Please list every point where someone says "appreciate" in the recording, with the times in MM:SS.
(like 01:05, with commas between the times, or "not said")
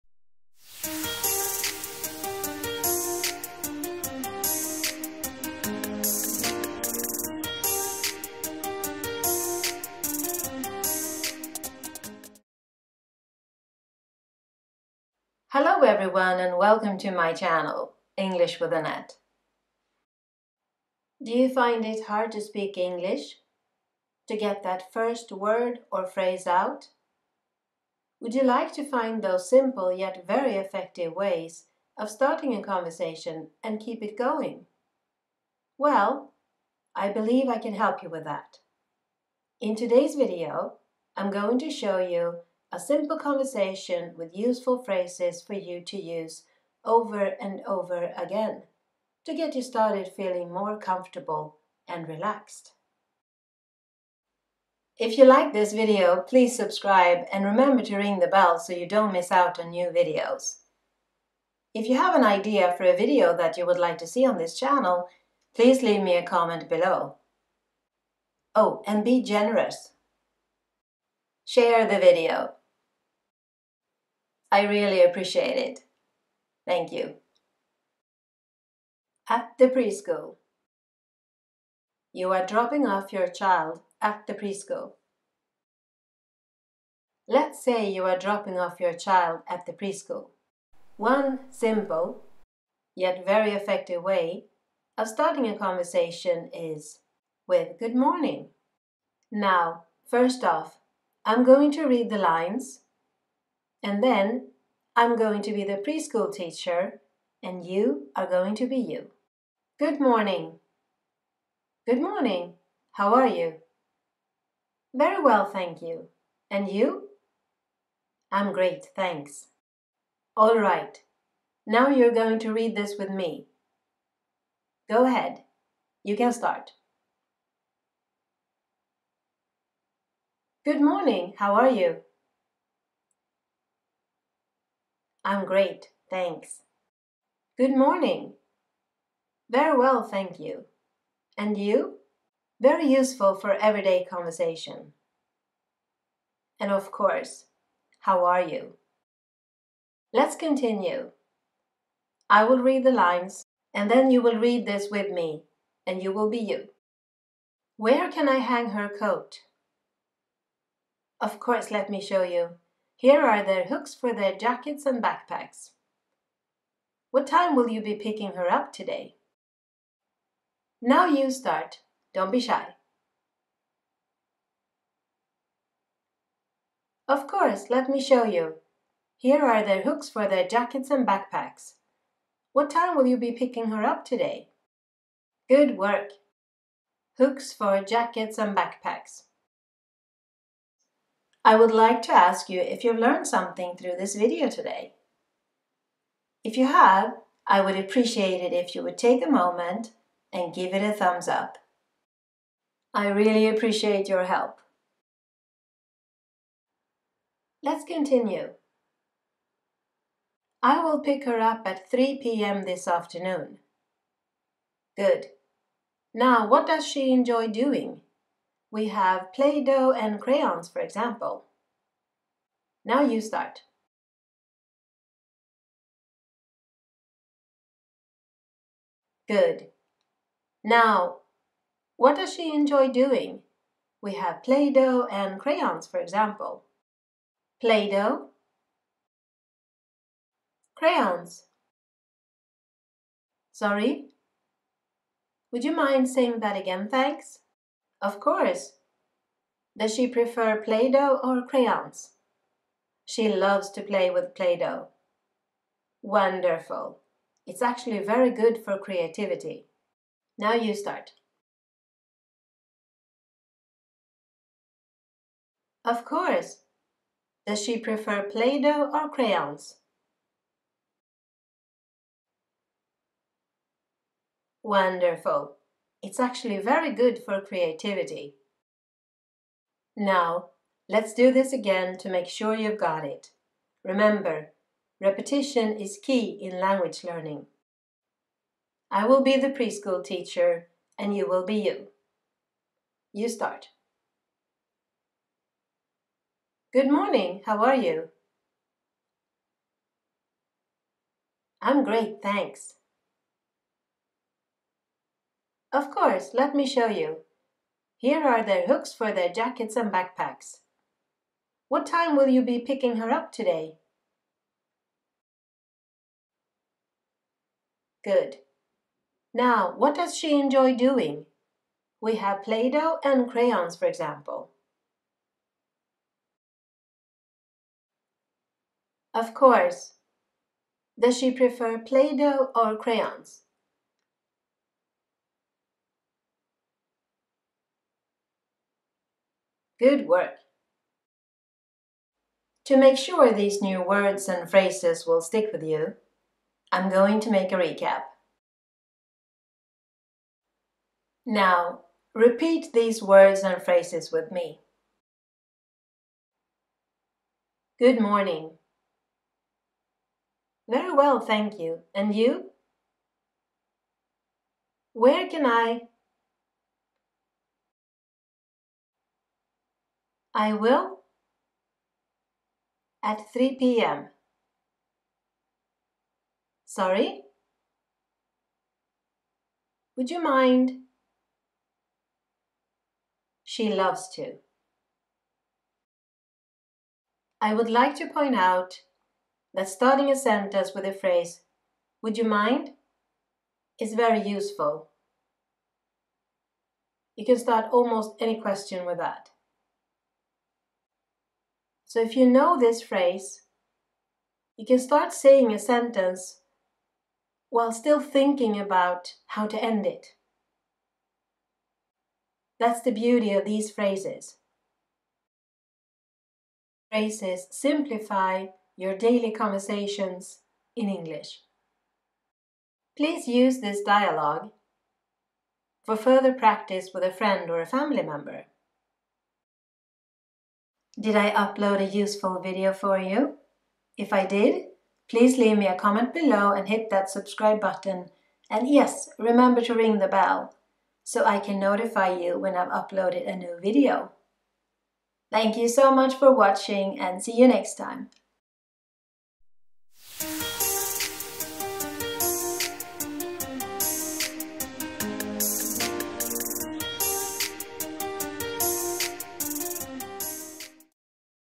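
01:15, 03:17, 03:23.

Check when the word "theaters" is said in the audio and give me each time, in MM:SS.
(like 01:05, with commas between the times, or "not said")
not said.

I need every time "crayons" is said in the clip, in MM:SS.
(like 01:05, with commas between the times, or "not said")
03:40, 03:55, 04:00, 04:11, 04:29, 05:23, 05:32.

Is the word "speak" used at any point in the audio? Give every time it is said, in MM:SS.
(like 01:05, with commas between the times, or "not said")
00:22.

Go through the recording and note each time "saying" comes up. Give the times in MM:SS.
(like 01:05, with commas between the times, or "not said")
04:06, 06:45.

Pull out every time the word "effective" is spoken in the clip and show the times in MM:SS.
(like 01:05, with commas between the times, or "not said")
00:30, 01:33.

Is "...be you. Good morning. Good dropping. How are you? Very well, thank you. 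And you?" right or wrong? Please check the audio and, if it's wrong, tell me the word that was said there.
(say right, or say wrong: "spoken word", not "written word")
wrong: "morning", not "dropping".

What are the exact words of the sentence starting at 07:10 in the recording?
Did I upload a useful video for you?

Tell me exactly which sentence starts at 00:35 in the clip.
Well, I believe I can help you with that.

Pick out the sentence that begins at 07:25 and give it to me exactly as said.
Thank you so much for watching and see you next time.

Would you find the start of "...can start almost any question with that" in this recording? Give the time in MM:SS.
06:37.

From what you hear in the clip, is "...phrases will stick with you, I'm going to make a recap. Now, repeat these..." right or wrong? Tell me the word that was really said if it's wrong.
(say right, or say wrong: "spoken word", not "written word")
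right.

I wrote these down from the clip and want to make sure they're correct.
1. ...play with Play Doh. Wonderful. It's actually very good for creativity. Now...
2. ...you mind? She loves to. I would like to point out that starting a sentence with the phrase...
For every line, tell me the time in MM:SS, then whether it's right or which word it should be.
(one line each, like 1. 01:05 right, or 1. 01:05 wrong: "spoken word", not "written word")
1. 04:13 right
2. 06:20 right.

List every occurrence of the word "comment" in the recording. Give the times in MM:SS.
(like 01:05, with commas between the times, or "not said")
01:06, 07:15.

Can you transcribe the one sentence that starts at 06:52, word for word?
That's the beauty of these phrases.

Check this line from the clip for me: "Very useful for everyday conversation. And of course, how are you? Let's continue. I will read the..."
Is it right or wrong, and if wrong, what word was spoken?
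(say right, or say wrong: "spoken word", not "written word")
right.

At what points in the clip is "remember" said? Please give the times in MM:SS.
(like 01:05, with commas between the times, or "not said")
00:57, 04:43, 07:19.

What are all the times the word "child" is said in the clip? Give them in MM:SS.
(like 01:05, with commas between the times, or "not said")
01:23, 01:28.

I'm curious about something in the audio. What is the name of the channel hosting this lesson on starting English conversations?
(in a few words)
English with Anette.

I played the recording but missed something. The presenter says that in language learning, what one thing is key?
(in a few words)
Repetition.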